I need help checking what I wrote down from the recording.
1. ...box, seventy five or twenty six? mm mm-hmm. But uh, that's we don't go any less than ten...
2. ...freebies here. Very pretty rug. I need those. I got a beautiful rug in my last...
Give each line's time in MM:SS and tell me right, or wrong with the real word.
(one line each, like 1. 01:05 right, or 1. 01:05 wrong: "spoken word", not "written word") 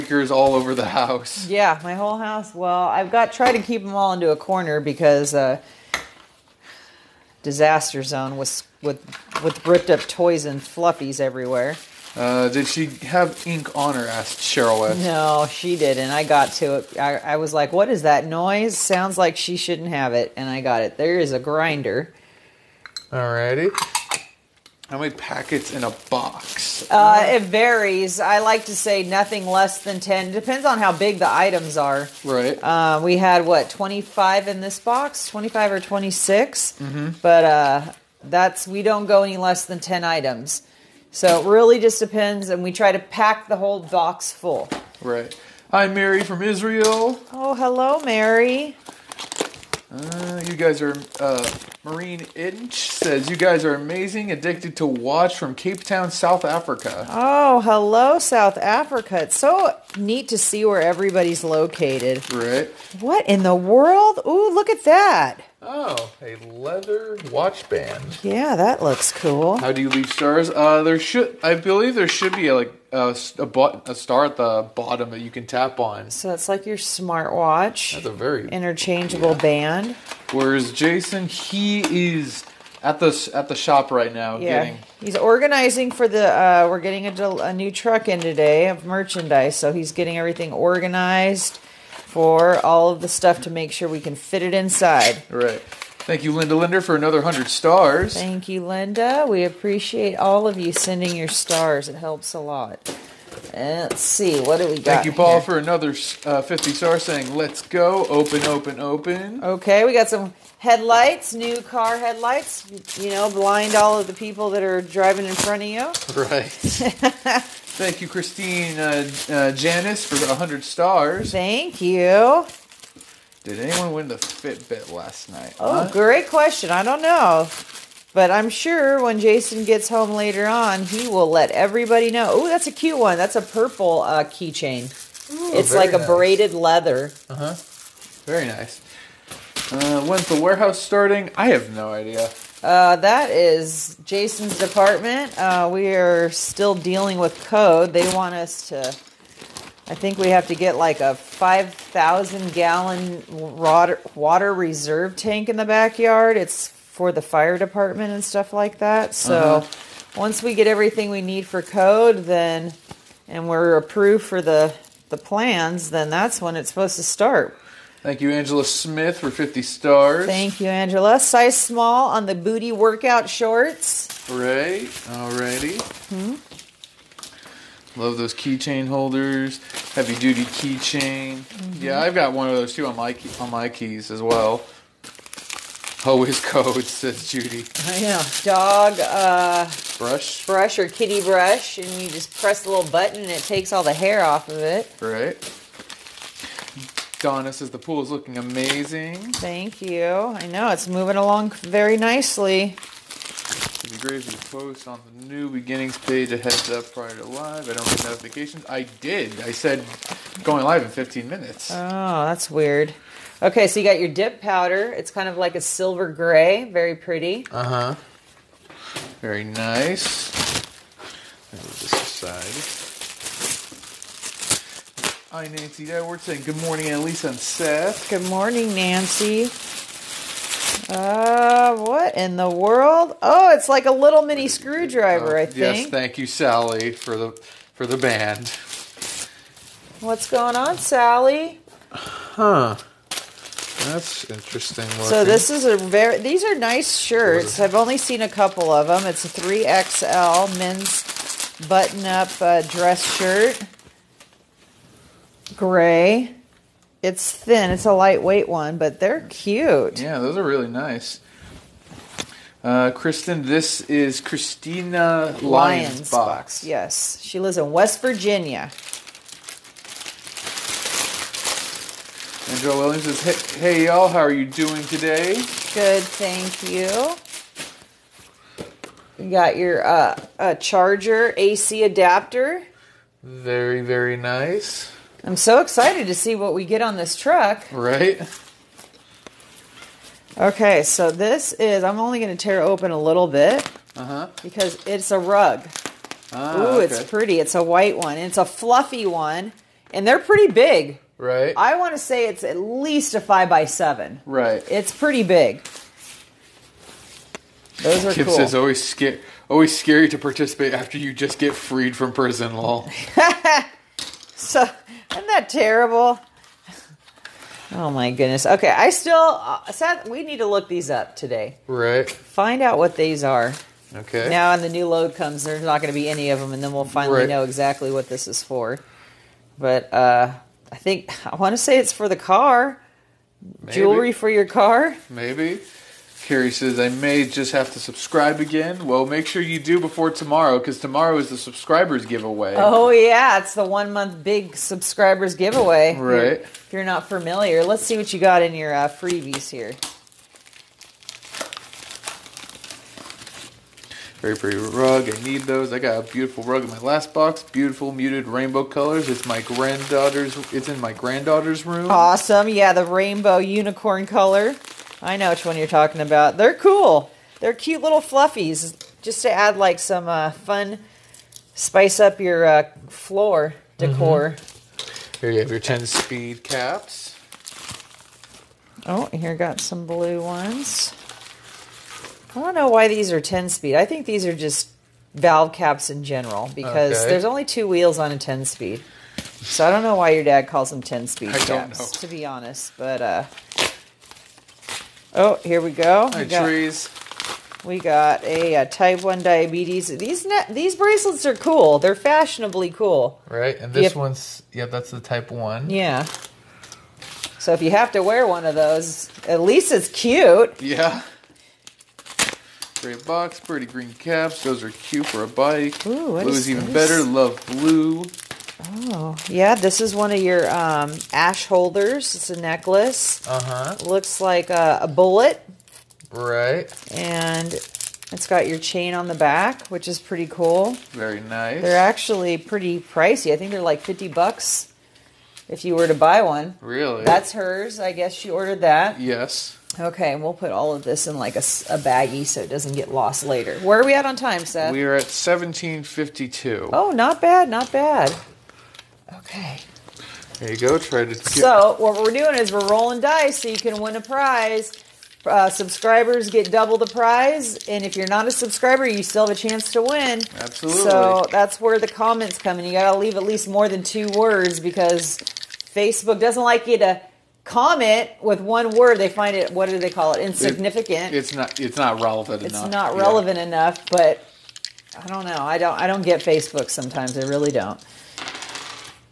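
1. 00:34 wrong: "twenty", not "seventy"
2. 05:48 right.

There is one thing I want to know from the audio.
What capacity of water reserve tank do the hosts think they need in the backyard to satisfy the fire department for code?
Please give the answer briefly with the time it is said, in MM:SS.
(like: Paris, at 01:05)
5,000 gallons, at 02:31.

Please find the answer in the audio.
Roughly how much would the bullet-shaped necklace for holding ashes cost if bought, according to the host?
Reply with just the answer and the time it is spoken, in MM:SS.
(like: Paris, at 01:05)
$50, at 07:13.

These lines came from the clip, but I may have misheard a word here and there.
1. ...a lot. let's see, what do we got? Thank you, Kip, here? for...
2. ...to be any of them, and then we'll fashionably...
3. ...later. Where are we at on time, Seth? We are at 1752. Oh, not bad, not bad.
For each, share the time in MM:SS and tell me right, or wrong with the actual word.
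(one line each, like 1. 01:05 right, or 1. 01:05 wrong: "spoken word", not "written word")
1. 01:42 wrong: "Paul", not "Kip"
2. 05:25 wrong: "finally", not "fashionably"
3. 07:23 right.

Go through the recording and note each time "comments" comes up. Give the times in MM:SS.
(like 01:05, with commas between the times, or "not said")
07:41, 07:47.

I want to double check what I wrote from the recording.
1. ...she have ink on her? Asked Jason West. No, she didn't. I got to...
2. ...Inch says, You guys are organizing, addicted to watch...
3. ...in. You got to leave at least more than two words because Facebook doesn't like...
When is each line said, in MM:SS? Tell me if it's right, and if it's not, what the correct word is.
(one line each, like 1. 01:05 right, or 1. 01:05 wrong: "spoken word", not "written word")
1. 00:12 wrong: "Cheryl", not "Jason"
2. 00:52 wrong: "amazing", not "organizing"
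3. 07:42 right.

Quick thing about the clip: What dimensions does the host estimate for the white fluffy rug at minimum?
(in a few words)
5 by 7.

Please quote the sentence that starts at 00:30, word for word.
Depends on how big the items are.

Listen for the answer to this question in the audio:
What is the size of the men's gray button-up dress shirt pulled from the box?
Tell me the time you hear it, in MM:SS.
04:09.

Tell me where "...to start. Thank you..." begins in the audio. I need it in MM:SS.
02:46.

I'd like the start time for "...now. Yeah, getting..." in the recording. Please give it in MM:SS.
01:24.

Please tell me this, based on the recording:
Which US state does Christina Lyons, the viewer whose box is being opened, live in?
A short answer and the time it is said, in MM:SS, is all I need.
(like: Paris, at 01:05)
West Virginia, at 04:27.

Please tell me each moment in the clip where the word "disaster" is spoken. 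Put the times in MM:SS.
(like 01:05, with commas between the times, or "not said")
00:07.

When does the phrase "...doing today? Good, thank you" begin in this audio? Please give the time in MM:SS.
04:34.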